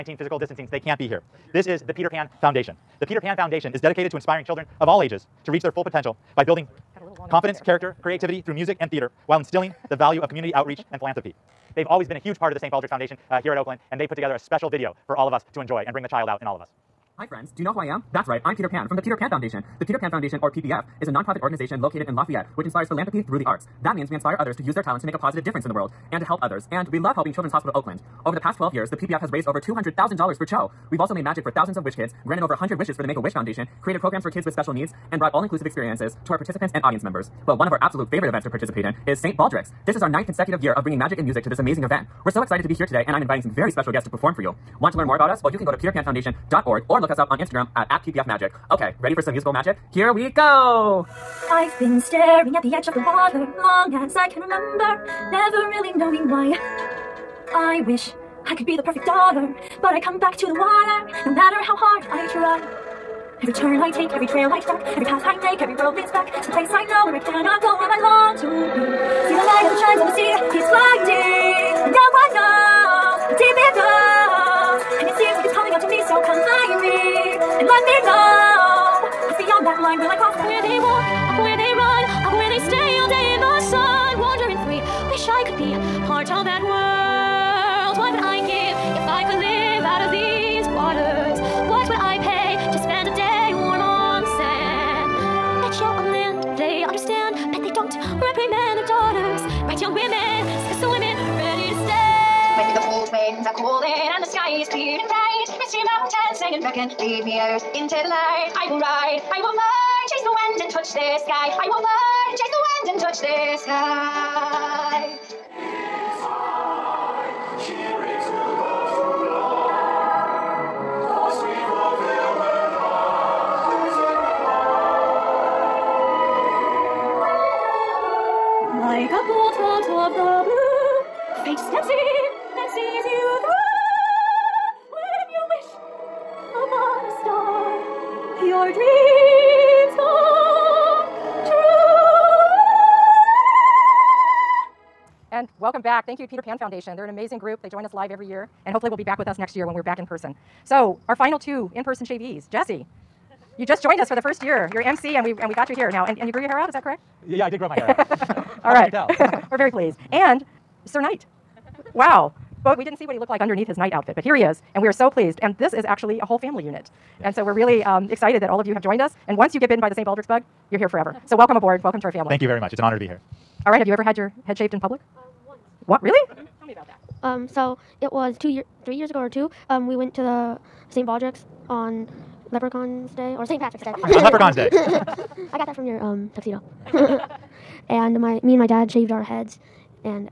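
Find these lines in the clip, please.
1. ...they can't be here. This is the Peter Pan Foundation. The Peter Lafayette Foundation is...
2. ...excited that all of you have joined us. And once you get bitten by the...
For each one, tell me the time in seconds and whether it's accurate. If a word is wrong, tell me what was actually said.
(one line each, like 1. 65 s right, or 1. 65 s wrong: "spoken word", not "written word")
1. 0 s wrong: "Pan", not "Lafayette"
2. 168 s right.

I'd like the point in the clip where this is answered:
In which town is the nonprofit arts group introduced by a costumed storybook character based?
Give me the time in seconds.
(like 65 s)
22 s.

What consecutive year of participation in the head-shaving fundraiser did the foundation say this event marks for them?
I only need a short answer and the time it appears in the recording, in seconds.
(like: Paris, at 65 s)
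ninth, at 40 s.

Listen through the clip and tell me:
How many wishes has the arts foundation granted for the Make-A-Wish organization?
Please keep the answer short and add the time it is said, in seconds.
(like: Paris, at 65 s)
over 100, at 32 s.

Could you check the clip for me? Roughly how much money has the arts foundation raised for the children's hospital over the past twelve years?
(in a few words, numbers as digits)
over $200,000.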